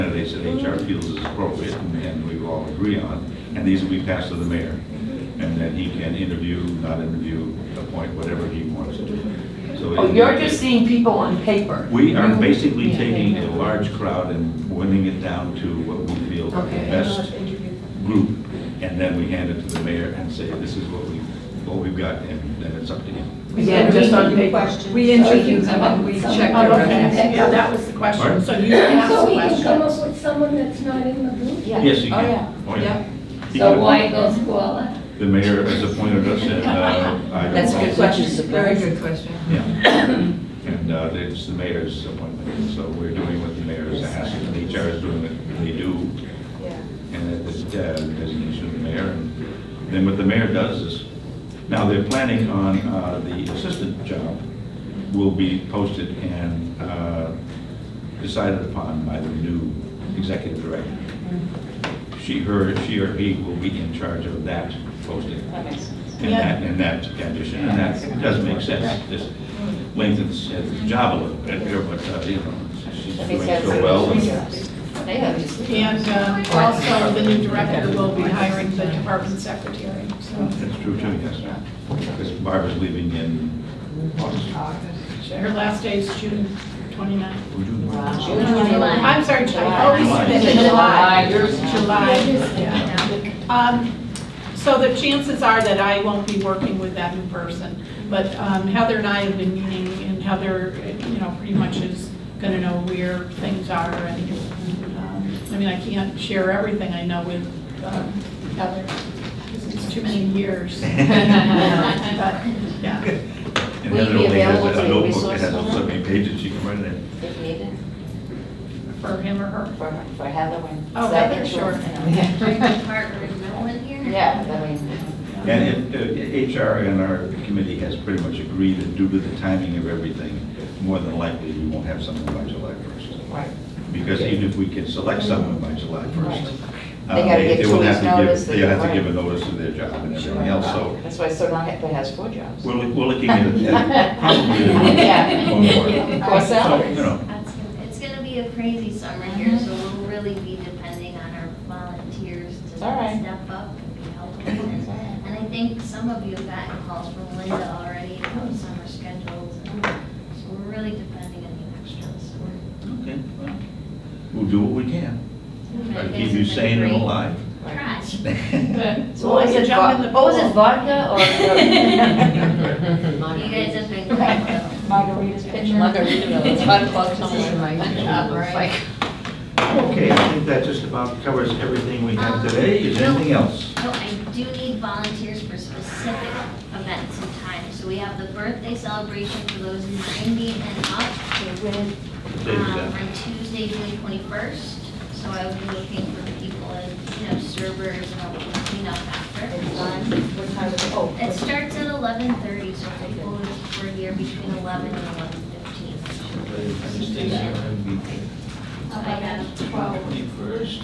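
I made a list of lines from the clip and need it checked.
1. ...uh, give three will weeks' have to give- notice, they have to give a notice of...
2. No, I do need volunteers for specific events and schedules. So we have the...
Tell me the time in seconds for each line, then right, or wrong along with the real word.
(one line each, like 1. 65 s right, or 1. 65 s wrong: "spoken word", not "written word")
1. 137 s wrong: "two", not "three"
2. 183 s wrong: "times", not "schedules".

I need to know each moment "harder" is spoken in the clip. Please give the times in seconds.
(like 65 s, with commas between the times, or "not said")
not said.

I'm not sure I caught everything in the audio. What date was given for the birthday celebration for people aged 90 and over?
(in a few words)
Tuesday, June 21st.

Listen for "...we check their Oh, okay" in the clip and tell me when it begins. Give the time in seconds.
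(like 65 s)
26 s.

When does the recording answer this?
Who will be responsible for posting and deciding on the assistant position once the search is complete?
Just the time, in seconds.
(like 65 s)
59 s.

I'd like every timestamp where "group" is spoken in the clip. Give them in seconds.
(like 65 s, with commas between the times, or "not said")
18 s, 31 s.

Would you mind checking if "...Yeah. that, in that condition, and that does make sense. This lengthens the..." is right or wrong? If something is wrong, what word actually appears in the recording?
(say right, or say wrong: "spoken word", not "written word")
right.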